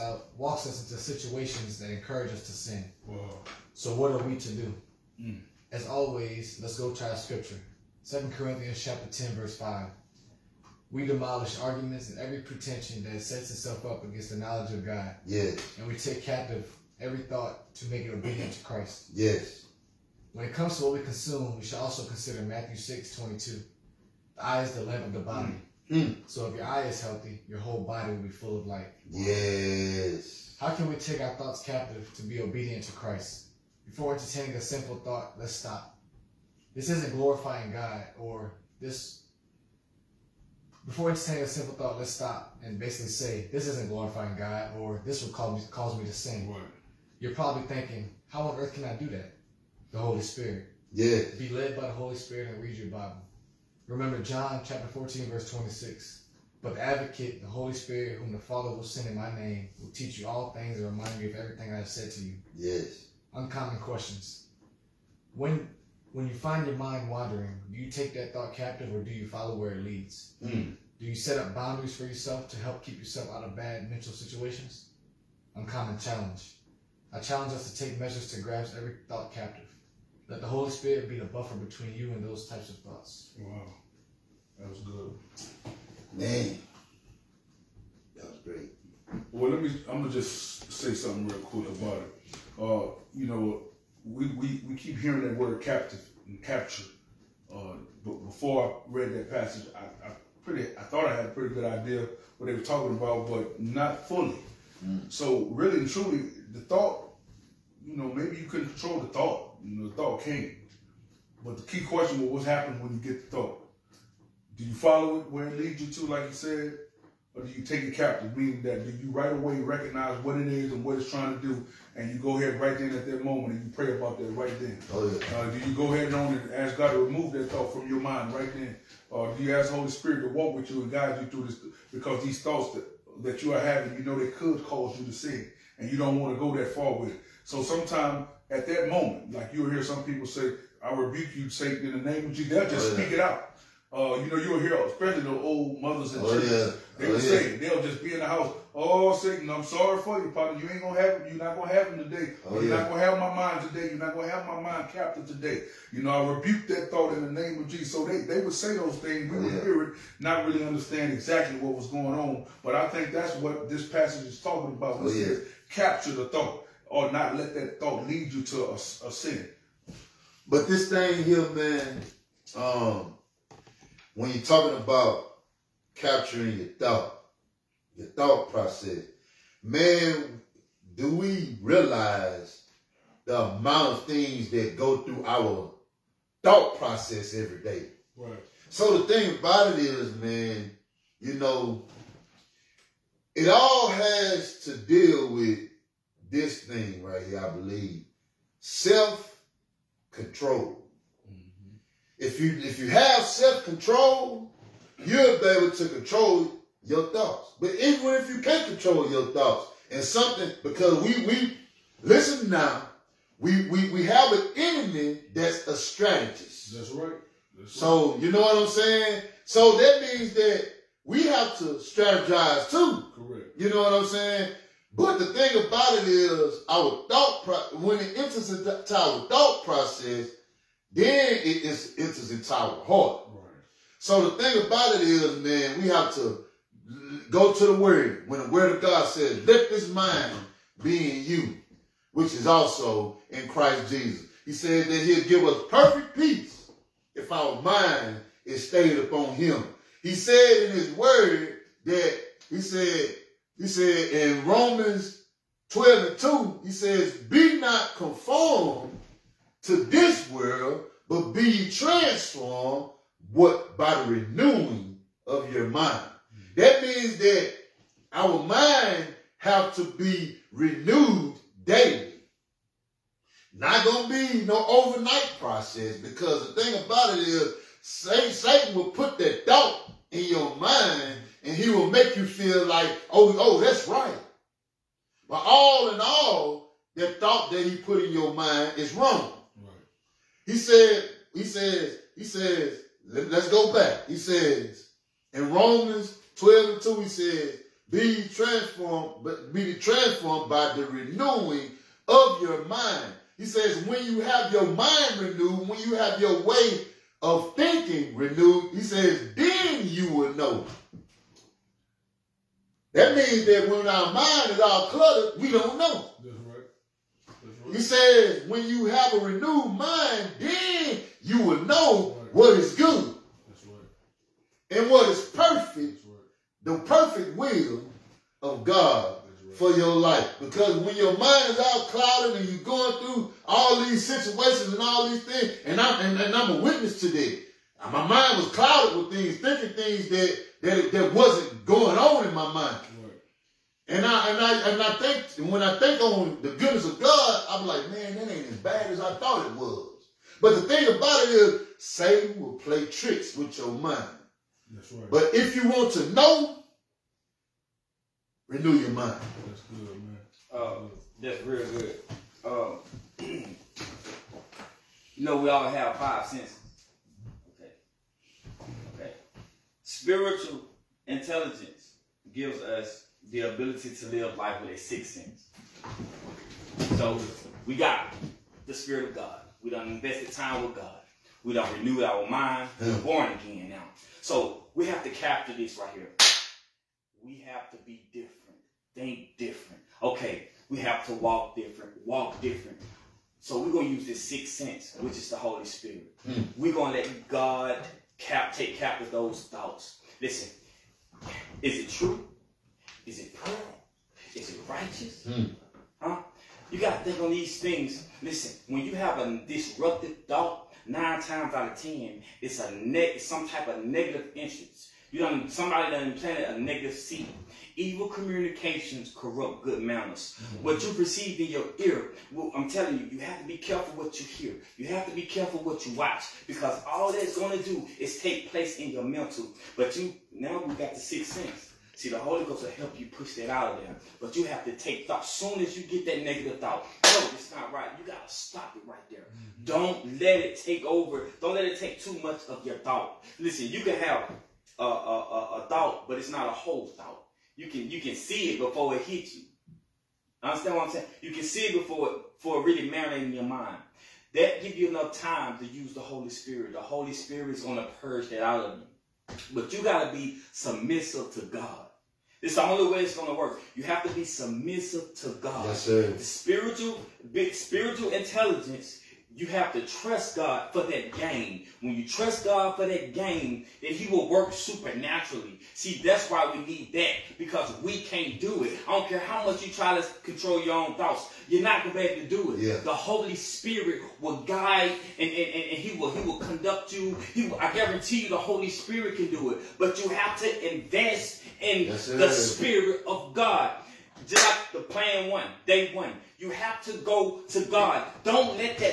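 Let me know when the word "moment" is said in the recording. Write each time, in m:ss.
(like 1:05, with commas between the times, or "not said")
2:03, 2:18.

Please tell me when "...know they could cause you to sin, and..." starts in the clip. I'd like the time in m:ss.
2:14.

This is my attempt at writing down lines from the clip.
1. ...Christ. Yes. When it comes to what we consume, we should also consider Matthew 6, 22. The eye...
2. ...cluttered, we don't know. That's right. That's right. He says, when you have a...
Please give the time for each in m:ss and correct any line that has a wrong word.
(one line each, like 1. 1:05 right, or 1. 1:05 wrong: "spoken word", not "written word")
1. 0:18 right
2. 5:14 right.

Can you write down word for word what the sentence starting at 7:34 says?
That give you enough time to use the Holy Spirit.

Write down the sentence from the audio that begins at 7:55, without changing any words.
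See, that's why we need that because we can't do it.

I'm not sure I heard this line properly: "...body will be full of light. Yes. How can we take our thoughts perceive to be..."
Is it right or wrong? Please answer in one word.
wrong.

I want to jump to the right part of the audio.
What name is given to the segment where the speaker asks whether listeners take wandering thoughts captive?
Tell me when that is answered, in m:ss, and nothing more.
1:03.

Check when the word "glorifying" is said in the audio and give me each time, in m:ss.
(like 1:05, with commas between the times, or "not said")
0:37, 0:43.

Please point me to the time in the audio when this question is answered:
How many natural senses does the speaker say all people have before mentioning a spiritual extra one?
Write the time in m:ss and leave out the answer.
6:05.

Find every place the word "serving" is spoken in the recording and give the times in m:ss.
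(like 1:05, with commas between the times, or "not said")
not said.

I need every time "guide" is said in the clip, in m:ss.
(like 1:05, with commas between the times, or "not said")
2:10, 8:04.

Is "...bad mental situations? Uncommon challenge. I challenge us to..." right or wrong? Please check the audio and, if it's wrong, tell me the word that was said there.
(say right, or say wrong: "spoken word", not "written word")
right.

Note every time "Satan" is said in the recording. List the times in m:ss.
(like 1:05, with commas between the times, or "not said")
2:21, 2:29, 4:37, 5:51.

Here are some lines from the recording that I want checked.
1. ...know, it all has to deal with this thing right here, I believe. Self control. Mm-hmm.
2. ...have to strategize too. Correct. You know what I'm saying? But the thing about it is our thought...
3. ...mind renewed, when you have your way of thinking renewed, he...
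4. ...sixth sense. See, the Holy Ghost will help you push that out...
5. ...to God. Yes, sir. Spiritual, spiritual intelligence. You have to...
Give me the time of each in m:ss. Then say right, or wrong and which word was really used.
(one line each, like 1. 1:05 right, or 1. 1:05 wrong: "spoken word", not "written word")
1. 3:11 right
2. 3:41 right
3. 5:04 right
4. 7:10 right
5. 7:45 right.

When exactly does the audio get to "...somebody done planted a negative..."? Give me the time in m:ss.
6:55.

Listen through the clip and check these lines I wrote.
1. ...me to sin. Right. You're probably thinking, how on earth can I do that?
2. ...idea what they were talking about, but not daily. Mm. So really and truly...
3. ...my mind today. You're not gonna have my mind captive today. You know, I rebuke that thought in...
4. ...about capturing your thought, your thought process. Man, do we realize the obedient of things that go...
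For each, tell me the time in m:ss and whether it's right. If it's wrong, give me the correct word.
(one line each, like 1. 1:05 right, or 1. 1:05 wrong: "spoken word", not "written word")
1. 0:45 right
2. 1:41 wrong: "fully", not "daily"
3. 2:33 right
4. 2:54 wrong: "amount", not "obedient".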